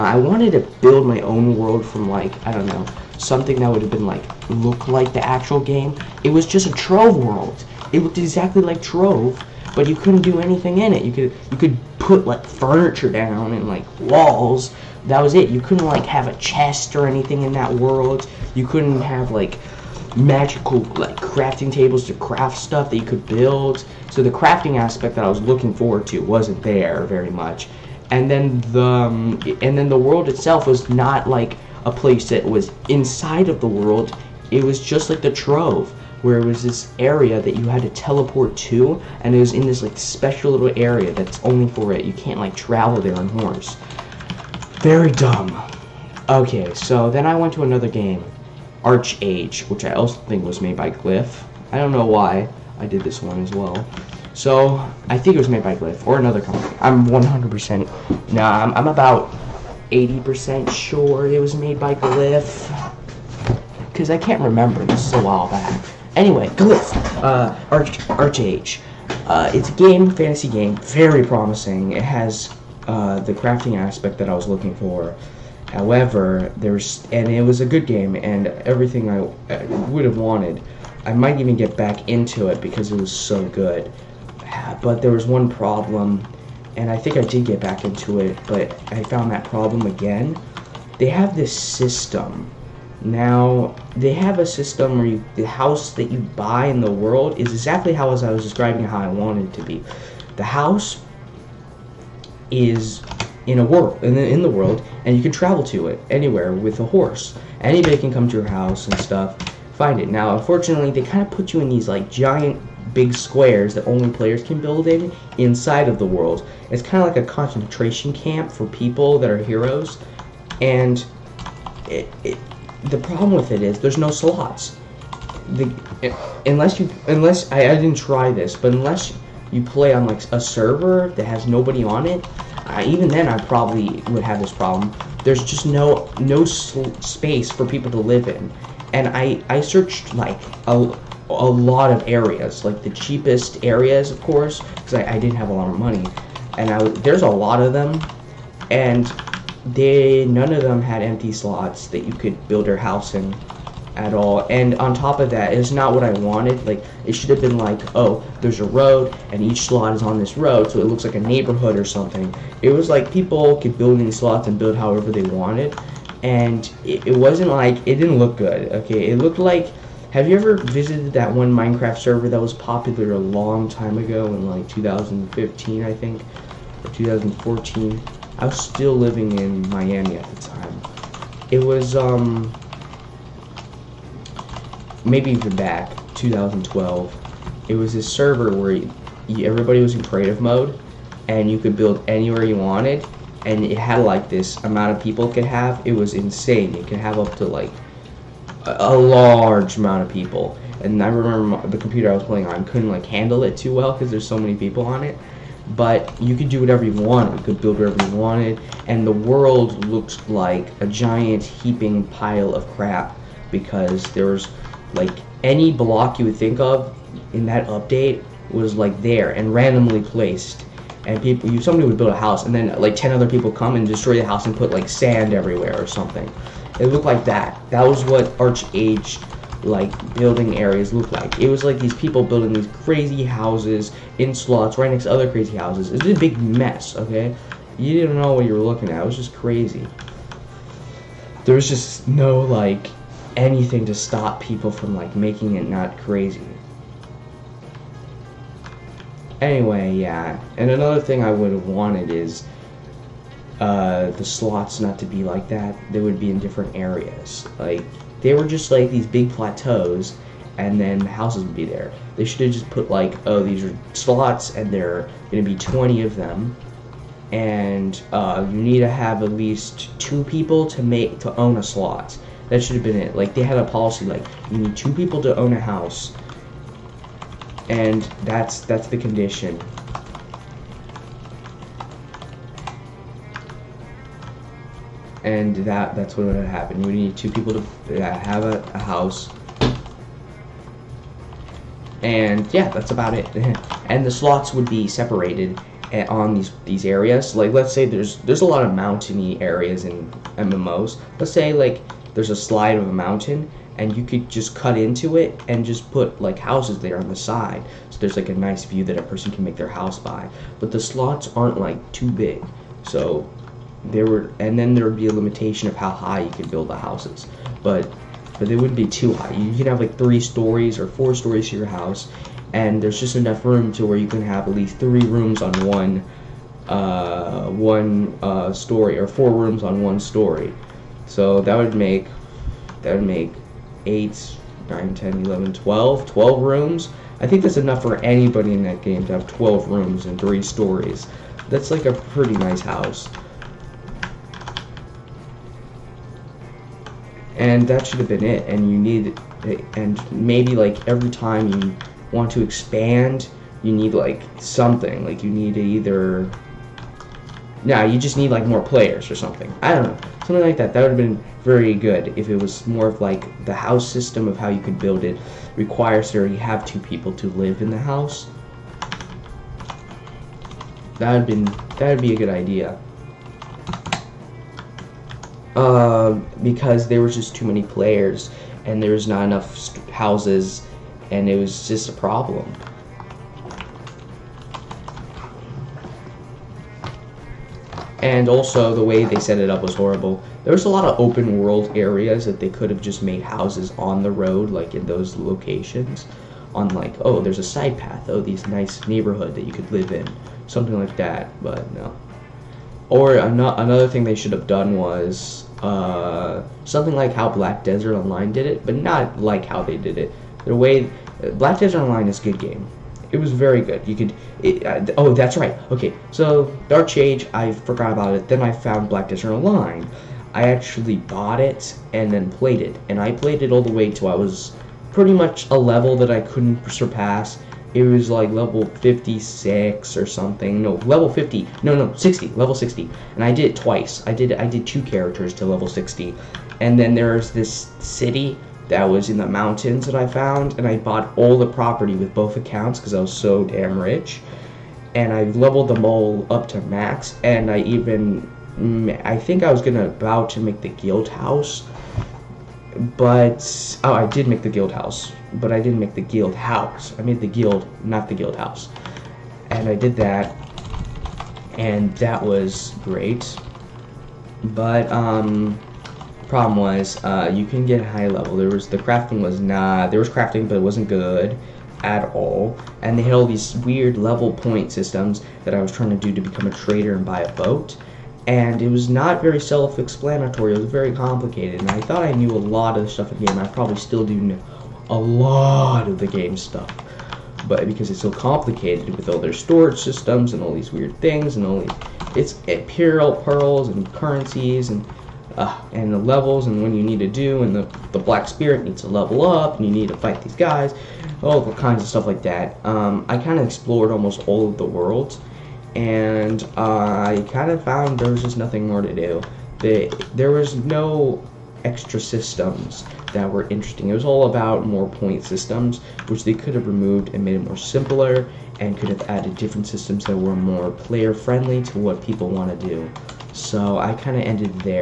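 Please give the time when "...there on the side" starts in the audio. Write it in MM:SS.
05:06.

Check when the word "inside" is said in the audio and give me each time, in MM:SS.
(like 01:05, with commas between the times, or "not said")
00:32, 01:55.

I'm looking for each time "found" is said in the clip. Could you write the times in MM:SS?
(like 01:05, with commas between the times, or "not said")
01:29, 06:58, 07:20, 08:27.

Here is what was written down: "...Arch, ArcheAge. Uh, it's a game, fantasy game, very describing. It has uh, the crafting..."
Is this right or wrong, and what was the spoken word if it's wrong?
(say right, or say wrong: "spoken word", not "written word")
wrong: "promising", not "describing".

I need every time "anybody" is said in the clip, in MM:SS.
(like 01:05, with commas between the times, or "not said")
01:47, 05:37.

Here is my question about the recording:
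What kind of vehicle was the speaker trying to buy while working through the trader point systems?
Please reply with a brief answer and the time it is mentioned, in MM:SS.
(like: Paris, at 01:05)
a boat, at 07:57.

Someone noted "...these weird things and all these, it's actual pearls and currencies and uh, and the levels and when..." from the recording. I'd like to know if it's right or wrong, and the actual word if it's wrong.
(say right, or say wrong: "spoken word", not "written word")
wrong: "imperial", not "actual".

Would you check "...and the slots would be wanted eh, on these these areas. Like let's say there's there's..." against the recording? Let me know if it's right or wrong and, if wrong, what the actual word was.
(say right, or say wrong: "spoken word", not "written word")
wrong: "separated", not "wanted".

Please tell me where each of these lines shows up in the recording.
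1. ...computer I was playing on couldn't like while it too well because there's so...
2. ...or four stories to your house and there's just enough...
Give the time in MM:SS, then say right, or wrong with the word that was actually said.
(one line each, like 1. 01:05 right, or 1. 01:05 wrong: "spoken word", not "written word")
1. 03:21 wrong: "handle", not "while"
2. 05:20 right.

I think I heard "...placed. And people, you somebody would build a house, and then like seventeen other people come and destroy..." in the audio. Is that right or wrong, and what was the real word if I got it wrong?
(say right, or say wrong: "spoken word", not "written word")
wrong: "ten", not "seventeen".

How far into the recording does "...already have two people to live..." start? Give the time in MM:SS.
06:06.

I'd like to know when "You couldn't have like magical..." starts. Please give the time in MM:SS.
00:18.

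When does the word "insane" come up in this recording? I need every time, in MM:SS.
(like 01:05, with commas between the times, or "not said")
03:16.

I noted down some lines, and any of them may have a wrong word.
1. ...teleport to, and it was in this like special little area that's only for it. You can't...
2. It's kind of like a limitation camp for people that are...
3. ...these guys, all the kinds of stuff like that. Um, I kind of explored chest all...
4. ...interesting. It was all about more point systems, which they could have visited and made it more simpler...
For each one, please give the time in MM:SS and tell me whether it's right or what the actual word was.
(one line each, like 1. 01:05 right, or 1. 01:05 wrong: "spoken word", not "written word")
1. 00:37 right
2. 01:56 wrong: "concentration", not "limitation"
3. 08:20 wrong: "almost", not "chest"
4. 08:33 wrong: "removed", not "visited".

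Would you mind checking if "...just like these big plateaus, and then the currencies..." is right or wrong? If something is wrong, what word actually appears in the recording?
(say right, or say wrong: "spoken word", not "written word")
wrong: "houses", not "currencies".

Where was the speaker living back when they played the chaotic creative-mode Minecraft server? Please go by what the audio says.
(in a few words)
Miami.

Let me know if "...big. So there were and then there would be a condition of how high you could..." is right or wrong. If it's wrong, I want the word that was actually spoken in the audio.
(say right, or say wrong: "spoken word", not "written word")
wrong: "limitation", not "condition".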